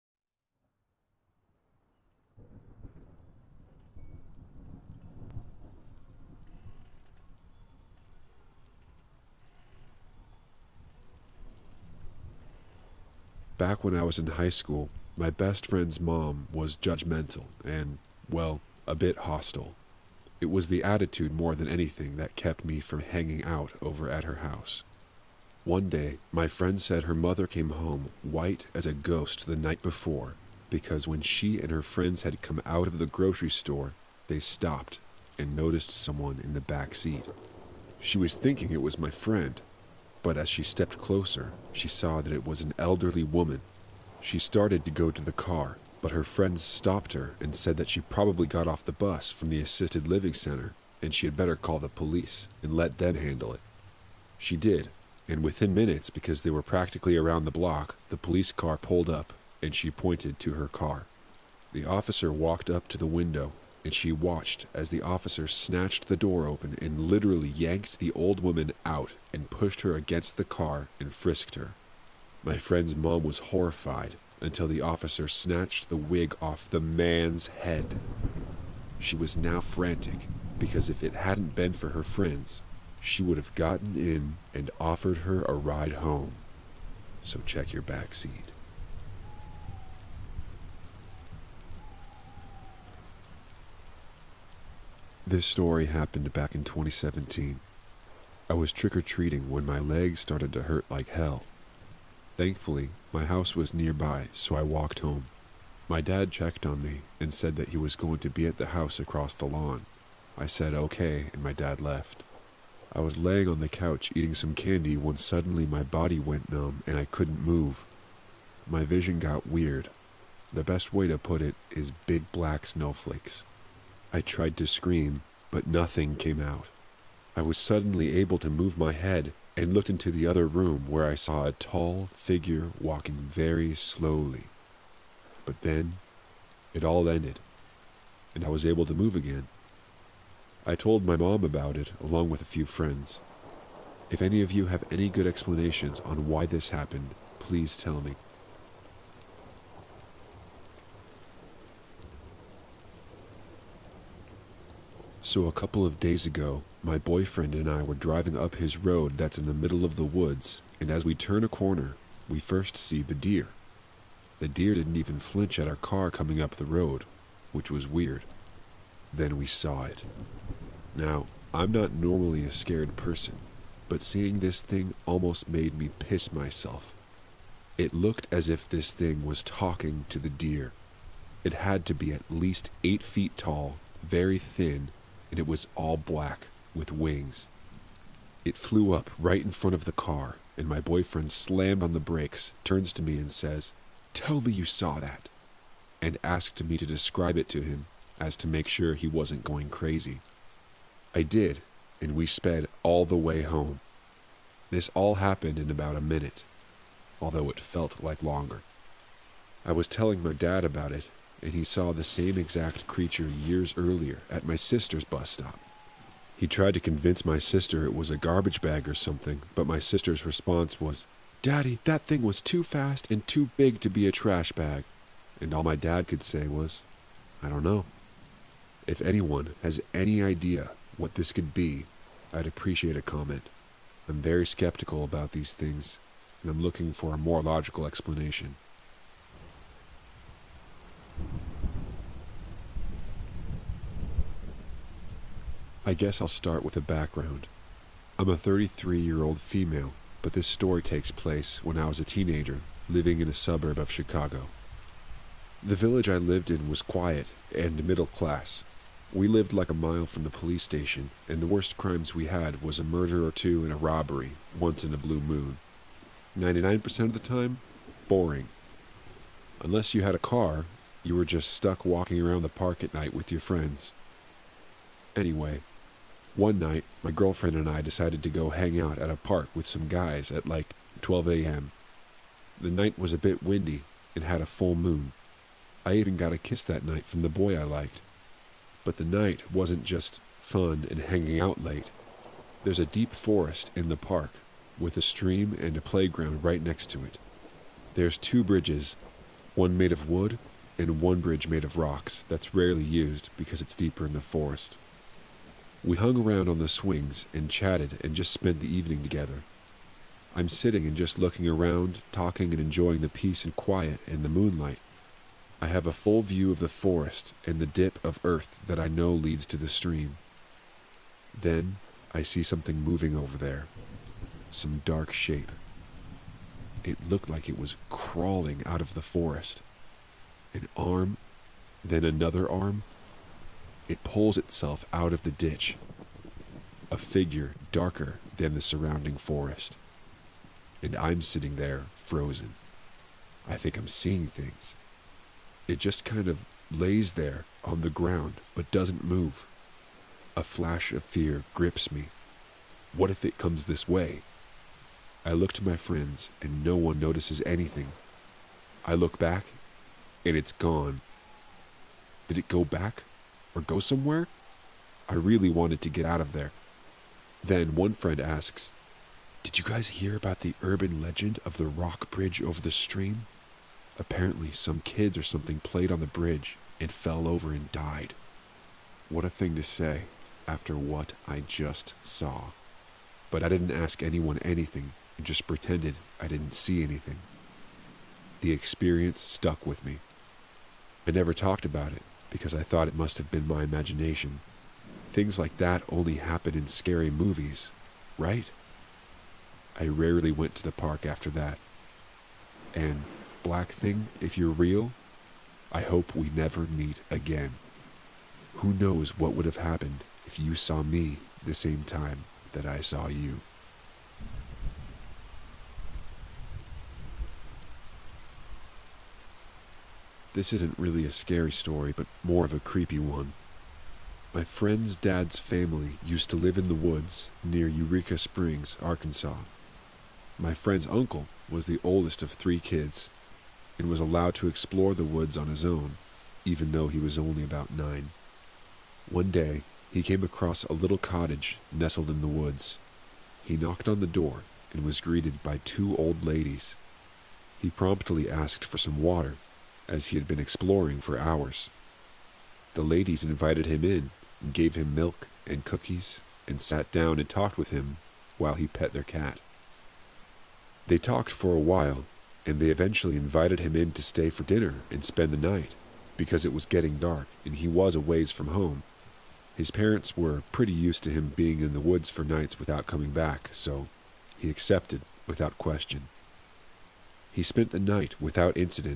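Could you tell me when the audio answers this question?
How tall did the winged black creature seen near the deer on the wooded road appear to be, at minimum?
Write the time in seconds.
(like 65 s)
182 s.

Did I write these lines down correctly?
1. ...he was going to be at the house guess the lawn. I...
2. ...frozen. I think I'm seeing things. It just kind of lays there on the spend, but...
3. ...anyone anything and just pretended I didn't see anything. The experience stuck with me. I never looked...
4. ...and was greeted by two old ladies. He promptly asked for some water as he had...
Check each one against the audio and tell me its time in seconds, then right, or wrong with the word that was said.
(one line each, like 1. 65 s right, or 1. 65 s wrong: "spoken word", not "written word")
1. 107 s wrong: "across", not "guess"
2. 341 s wrong: "ground", not "spend"
3. 384 s wrong: "talked", not "looked"
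4. 444 s right.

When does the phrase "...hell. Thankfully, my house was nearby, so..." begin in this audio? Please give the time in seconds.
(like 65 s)
101 s.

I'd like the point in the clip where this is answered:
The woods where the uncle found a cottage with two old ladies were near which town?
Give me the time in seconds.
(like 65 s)
427 s.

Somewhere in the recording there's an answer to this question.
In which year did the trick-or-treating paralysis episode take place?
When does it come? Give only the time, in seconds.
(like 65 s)
96 s.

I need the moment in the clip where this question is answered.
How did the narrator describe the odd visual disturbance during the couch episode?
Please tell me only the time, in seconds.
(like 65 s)
122 s.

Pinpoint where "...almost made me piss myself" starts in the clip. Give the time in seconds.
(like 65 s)
175 s.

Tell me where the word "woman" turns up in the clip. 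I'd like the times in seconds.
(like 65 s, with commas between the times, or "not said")
43 s, 68 s.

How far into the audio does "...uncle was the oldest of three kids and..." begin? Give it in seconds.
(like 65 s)
430 s.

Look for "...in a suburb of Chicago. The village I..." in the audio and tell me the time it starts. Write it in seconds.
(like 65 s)
253 s.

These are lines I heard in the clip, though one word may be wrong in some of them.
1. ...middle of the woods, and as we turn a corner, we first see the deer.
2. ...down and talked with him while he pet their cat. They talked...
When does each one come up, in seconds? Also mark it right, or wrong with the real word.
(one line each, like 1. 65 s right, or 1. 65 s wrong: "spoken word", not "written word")
1. 159 s right
2. 456 s right.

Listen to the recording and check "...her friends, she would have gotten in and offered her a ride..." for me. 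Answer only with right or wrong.
right.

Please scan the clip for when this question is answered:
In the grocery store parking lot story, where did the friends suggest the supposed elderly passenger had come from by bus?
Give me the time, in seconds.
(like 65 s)
49 s.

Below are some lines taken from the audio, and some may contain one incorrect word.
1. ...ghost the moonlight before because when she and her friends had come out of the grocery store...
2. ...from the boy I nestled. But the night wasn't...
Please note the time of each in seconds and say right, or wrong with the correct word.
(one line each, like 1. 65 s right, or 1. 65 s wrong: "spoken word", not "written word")
1. 28 s wrong: "night", not "moonlight"
2. 287 s wrong: "liked", not "nestled".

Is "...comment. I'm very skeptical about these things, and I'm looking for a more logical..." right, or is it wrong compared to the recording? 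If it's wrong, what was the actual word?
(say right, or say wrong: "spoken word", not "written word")
right.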